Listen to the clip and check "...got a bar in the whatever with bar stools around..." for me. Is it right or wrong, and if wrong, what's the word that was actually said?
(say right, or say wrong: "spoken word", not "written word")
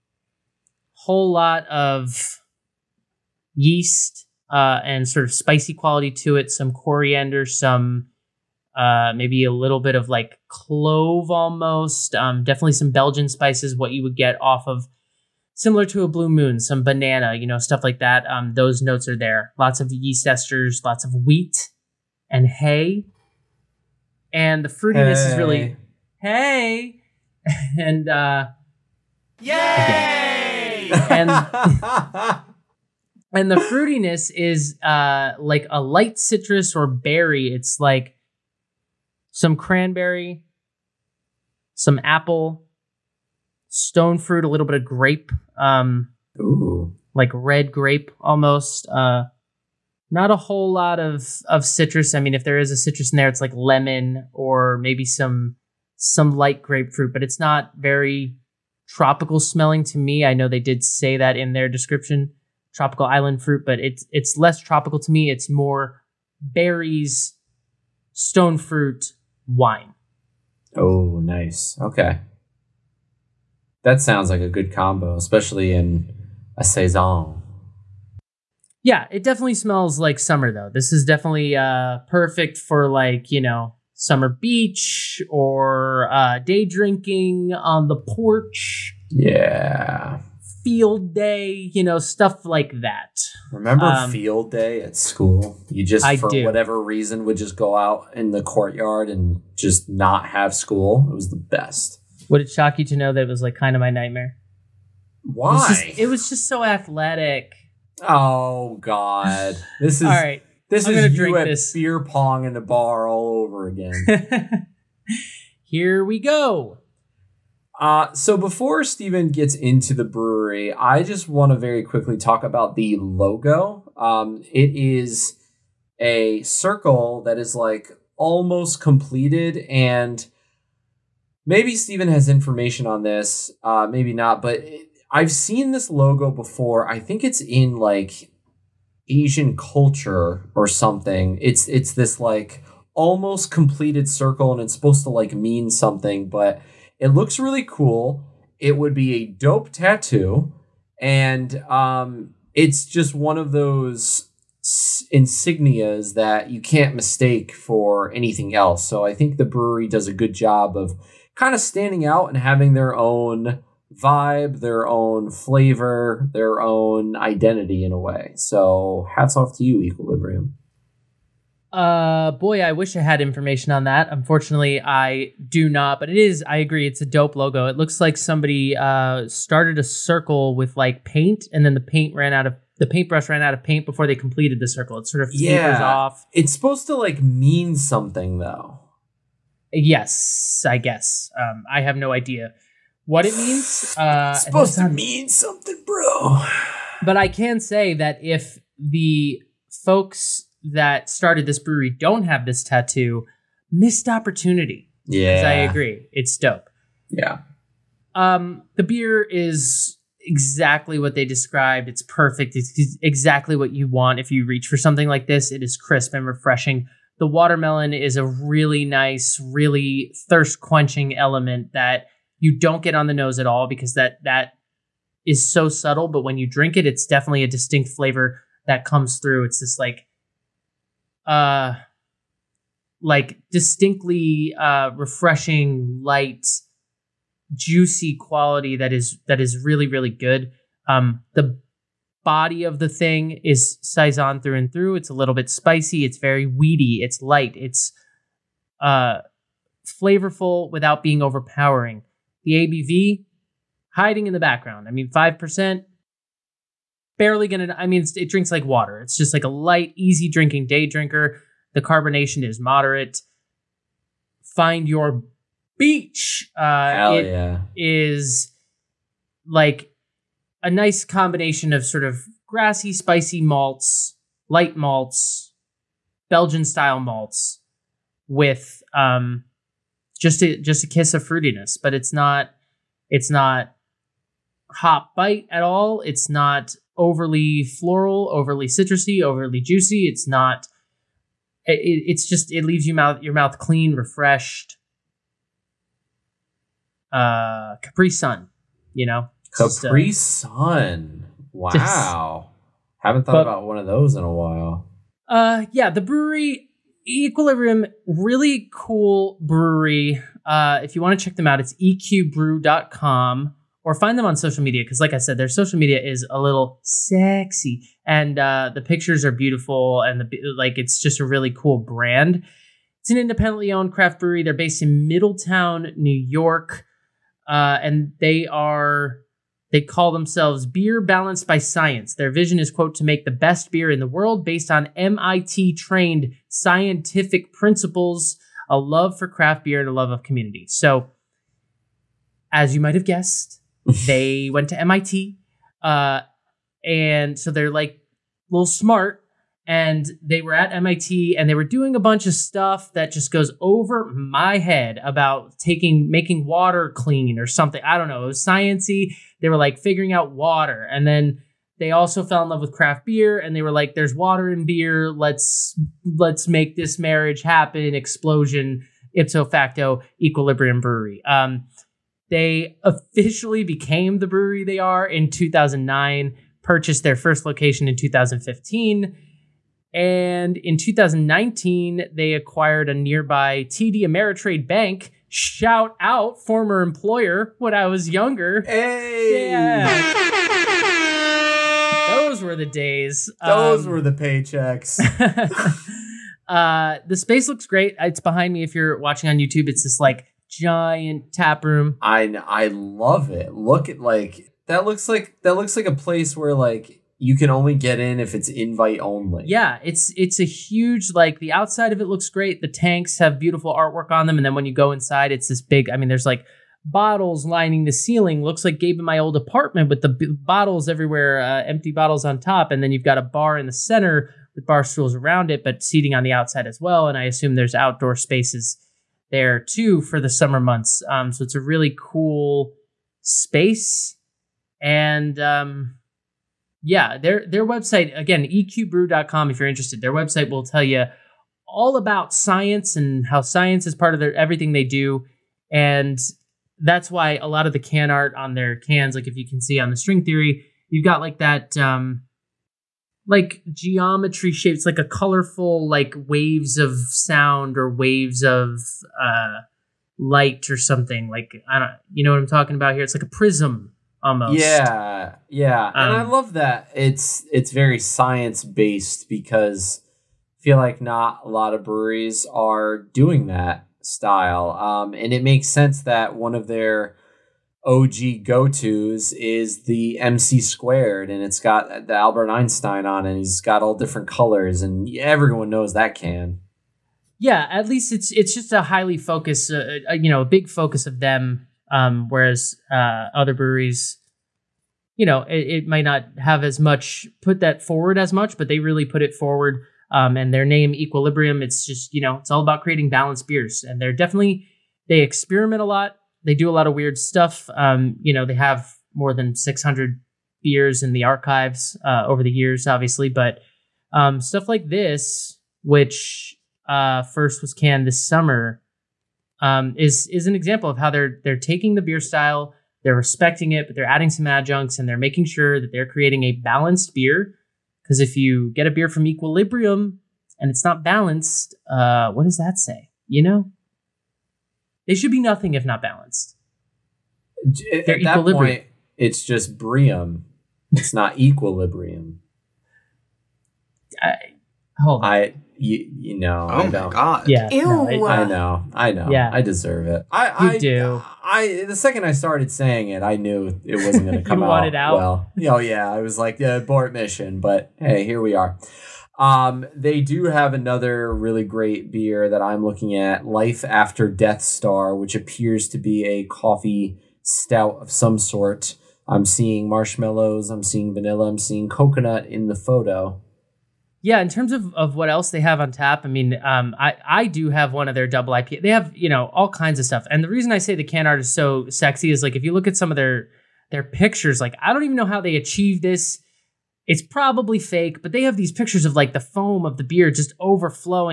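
wrong: "center", not "whatever".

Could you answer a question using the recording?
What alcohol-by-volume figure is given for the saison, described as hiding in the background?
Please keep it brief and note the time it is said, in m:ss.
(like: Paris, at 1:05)
5 percent, at 4:15.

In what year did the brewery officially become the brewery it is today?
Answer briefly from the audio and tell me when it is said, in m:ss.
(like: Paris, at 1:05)
2009, at 6:15.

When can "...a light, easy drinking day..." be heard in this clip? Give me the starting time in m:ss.
4:19.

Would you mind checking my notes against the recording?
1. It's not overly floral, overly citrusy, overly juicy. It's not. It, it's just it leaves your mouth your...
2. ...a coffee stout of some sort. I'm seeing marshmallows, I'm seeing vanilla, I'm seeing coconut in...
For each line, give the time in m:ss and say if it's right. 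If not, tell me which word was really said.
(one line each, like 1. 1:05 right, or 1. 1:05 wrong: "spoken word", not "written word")
1. 4:46 right
2. 9:26 right.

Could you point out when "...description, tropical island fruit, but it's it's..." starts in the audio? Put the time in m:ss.
1:01.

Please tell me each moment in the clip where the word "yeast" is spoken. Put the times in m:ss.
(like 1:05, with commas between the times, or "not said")
0:03, 0:19.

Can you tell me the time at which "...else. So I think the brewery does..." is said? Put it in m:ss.
2:38.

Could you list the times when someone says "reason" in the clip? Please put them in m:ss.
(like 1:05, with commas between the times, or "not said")
1:36, 9:40.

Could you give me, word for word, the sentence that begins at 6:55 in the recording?
I mean, there's like bottles lining the ceiling.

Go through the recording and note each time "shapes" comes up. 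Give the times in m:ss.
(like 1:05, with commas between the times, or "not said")
7:34.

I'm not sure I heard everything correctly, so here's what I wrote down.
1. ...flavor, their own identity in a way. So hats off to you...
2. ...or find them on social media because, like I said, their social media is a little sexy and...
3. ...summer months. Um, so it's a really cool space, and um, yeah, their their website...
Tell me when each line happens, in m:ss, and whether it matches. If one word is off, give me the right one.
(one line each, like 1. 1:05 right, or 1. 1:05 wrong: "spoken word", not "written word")
1. 2:45 right
2. 5:13 right
3. 7:10 right.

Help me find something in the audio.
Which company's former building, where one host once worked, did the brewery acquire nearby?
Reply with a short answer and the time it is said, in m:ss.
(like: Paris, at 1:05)
TD Ameritrade, at 6:23.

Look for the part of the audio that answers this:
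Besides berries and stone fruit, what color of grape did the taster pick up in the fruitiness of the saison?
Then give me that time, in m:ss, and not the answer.
0:47.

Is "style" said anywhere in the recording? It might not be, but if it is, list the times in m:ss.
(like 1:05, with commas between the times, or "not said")
4:36, 7:54, 8:42.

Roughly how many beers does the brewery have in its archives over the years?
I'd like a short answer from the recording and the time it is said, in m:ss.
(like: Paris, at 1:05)
More than 600, at 8:29.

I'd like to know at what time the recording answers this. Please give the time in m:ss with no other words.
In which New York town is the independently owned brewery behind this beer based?
5:25.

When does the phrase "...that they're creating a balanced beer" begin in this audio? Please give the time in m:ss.
8:45.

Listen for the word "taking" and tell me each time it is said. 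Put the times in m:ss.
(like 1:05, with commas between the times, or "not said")
5:55, 8:41.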